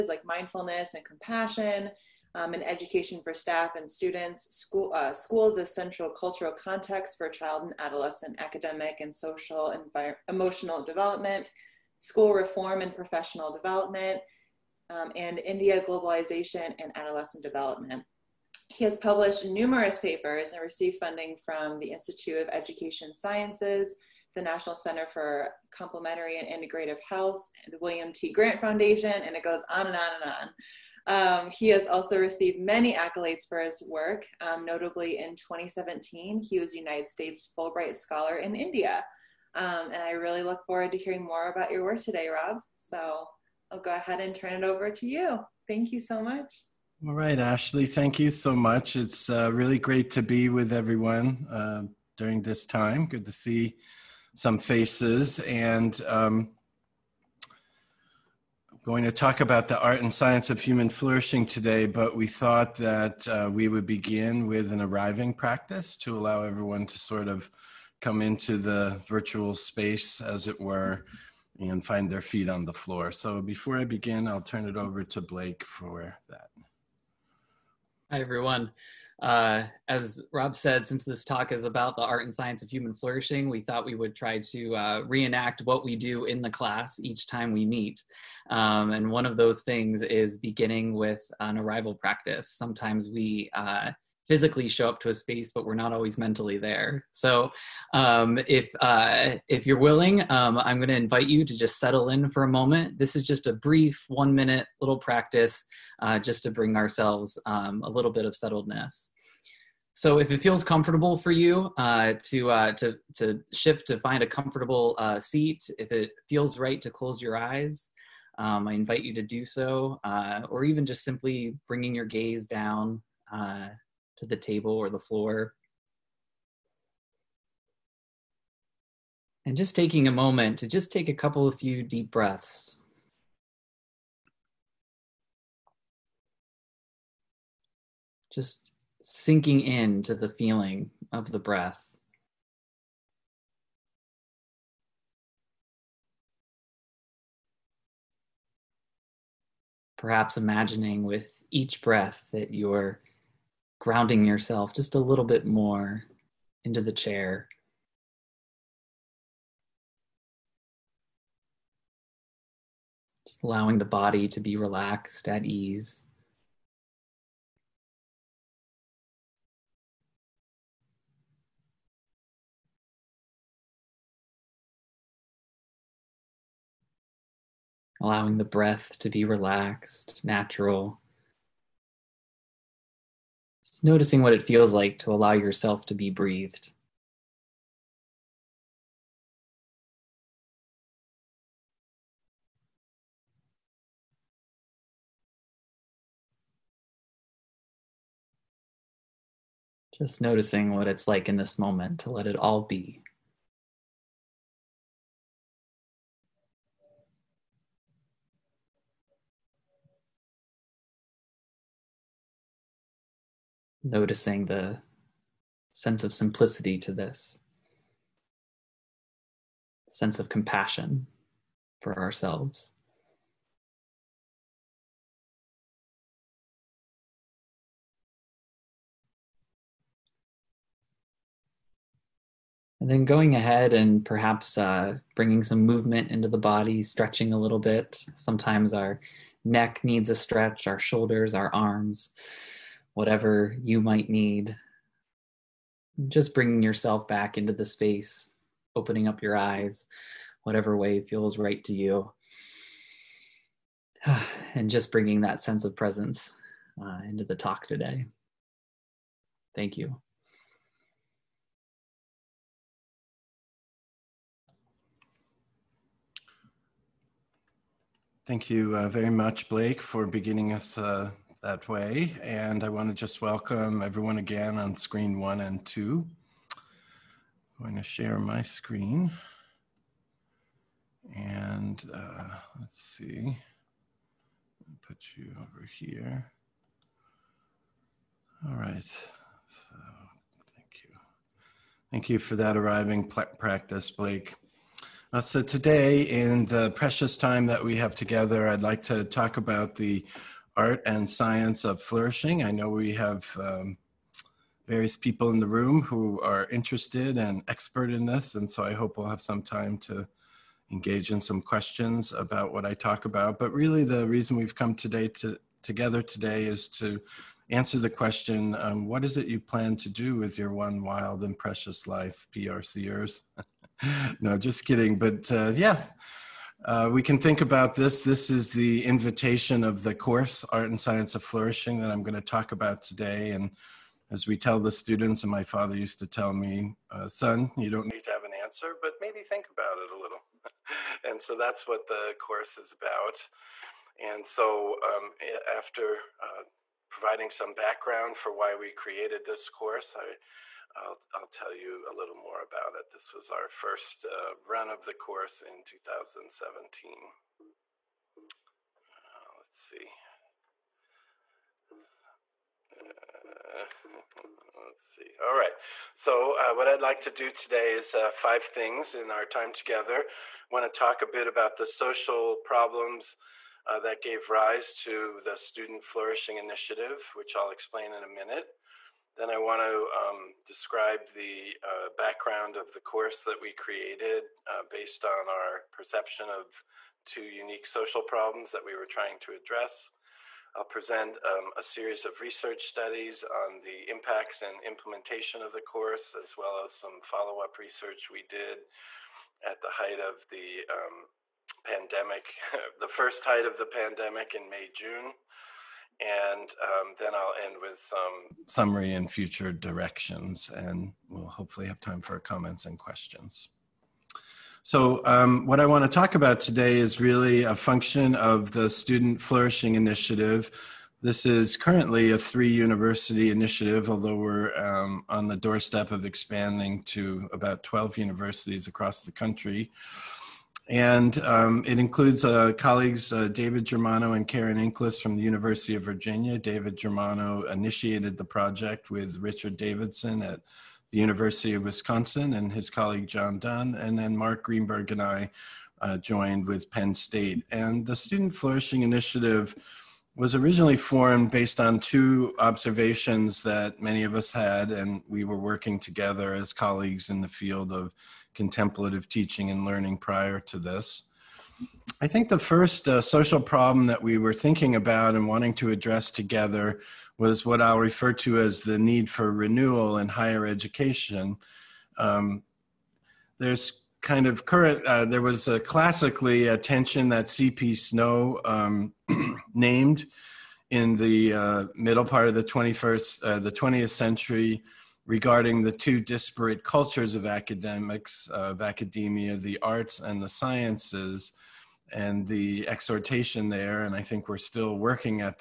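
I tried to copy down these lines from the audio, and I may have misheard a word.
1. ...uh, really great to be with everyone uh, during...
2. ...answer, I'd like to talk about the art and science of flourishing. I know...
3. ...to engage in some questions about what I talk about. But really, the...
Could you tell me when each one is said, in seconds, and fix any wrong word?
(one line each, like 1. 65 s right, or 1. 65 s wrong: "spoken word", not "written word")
1. 49 s right
2. 297 s wrong: "together", not "answer"
3. 309 s right.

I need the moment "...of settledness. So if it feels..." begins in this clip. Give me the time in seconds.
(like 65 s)
108 s.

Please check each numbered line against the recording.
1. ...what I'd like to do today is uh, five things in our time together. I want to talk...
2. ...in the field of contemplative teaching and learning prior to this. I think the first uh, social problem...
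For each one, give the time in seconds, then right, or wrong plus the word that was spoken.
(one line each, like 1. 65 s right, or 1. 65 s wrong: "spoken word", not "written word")
1. 366 s right
2. 457 s right.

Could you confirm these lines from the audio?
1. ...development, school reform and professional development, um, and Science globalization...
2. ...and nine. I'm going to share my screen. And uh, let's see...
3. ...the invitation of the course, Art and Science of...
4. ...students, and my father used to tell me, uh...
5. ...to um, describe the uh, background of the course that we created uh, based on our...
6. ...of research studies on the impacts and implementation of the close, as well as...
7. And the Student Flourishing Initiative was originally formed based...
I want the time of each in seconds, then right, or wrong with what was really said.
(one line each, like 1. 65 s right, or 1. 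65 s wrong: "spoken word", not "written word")
1. 10 s wrong: "India", not "Science"
2. 275 s wrong: "two", not "nine"
3. 328 s right
4. 334 s right
5. 379 s right
6. 392 s wrong: "course", not "close"
7. 447 s right.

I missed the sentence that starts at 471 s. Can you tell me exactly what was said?
Um, there's kind of current, uh, there was a classically a tension that C.P.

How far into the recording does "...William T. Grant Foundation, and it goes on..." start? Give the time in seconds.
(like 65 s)
27 s.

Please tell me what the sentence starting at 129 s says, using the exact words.
And just taking a moment to just take a couple of few deep breaths.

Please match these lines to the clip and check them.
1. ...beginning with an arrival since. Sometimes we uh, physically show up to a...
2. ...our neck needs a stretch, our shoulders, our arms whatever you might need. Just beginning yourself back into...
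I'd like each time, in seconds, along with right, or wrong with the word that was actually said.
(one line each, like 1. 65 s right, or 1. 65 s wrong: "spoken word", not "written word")
1. 90 s wrong: "practice", not "since"
2. 238 s wrong: "bringing", not "beginning".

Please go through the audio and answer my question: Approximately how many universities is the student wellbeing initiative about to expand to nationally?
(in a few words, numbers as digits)
12.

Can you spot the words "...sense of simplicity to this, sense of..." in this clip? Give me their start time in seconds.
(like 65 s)
215 s.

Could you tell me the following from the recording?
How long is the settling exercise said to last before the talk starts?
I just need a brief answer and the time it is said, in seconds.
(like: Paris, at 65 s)
one minute, at 104 s.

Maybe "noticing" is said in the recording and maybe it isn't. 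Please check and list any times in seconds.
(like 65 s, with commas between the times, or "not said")
183 s, 200 s, 213 s.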